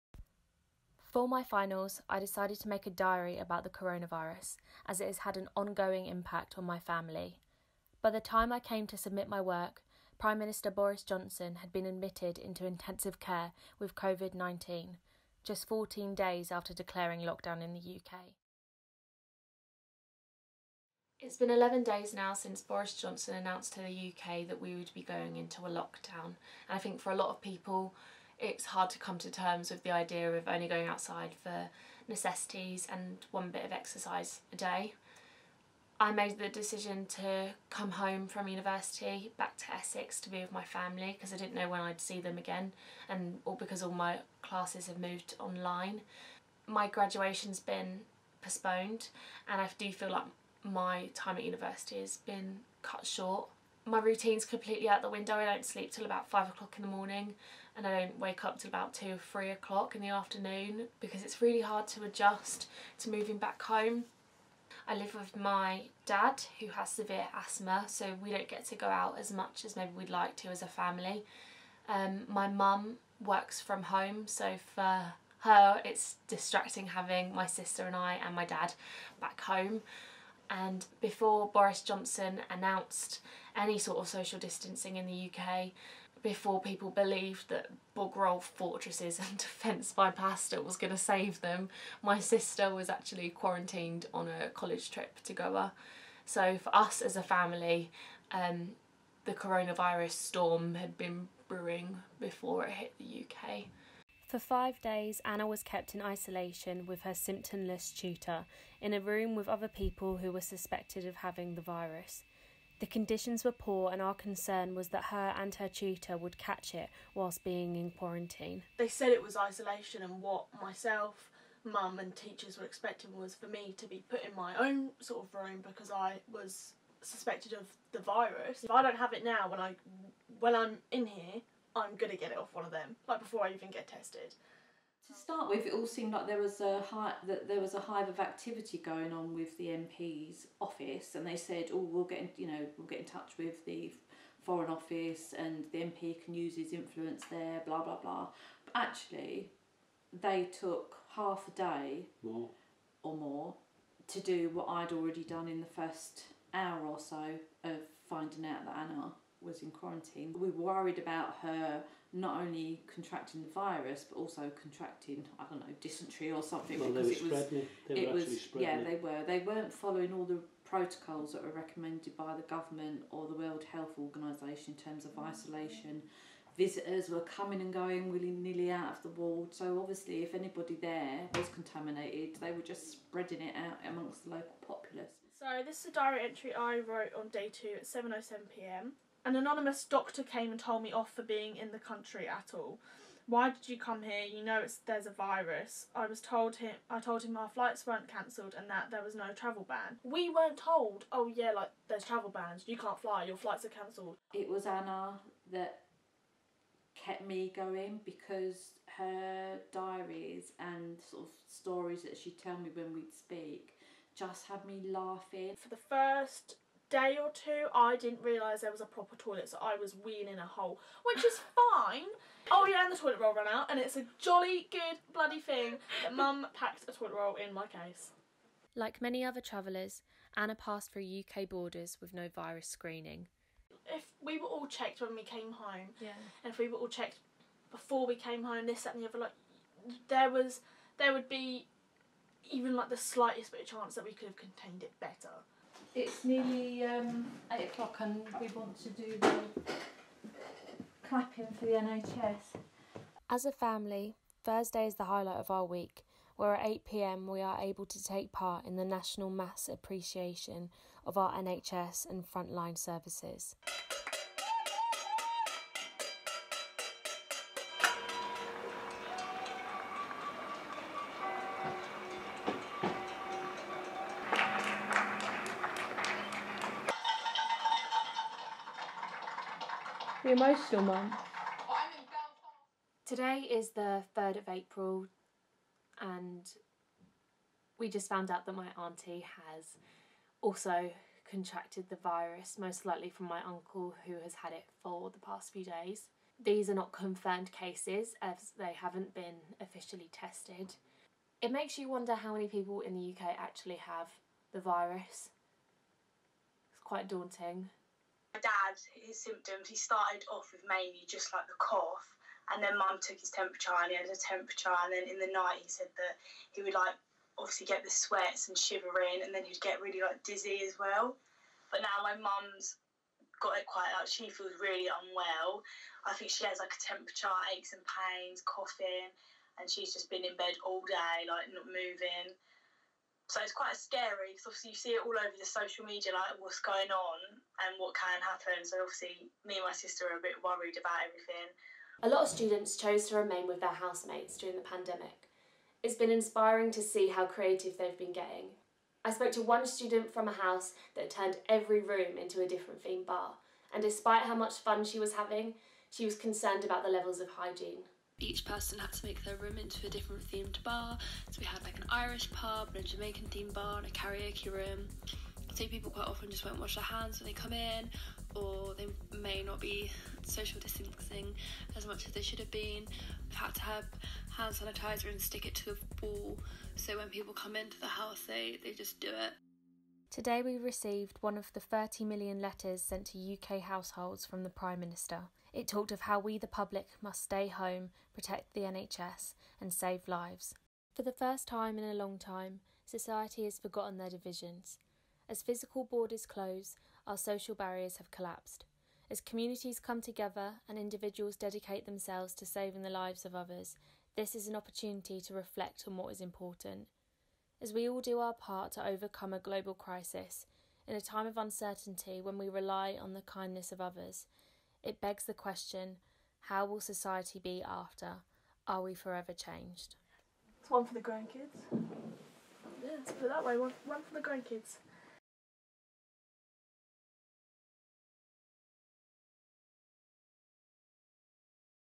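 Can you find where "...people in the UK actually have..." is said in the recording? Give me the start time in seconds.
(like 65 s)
302 s.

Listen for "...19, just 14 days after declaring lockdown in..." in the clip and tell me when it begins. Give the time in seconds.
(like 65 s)
14 s.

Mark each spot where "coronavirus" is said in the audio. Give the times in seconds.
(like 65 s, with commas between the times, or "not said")
3 s, 99 s.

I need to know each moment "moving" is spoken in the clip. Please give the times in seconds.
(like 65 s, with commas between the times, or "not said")
63 s, 331 s.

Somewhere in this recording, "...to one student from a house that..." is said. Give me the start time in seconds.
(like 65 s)
349 s.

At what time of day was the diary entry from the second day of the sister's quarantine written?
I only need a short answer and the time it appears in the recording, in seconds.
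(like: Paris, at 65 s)
7:07pm, at 187 s.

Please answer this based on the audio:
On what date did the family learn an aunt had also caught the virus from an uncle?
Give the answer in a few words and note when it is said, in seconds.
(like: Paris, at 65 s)
3rd of April, at 284 s.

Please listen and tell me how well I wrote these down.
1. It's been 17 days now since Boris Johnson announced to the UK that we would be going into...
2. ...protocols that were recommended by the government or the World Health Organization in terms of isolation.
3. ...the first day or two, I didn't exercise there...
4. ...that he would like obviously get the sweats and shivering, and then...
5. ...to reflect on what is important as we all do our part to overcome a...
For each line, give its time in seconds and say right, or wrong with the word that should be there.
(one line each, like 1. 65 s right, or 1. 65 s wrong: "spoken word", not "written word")
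1. 21 s wrong: "11", not "17"
2. 170 s right
3. 215 s wrong: "realise", not "exercise"
4. 315 s right
5. 405 s right.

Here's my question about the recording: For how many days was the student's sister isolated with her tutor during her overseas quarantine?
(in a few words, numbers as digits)
5.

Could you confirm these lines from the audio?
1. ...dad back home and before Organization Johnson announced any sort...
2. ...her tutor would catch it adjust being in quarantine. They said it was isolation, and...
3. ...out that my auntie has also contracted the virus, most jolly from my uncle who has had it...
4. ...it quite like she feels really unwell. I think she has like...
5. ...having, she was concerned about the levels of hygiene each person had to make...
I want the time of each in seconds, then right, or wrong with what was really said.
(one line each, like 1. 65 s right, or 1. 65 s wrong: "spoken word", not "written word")
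1. 78 s wrong: "Boris", not "Organization"
2. 115 s wrong: "whilst", not "adjust"
3. 288 s wrong: "likely", not "jolly"
4. 323 s right
5. 355 s right.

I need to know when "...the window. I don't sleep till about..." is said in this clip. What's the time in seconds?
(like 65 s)
55 s.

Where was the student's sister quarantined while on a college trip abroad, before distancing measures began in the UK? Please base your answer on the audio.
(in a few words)
Goa.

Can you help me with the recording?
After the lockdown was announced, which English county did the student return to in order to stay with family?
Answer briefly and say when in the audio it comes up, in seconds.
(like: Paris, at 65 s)
Essex, at 39 s.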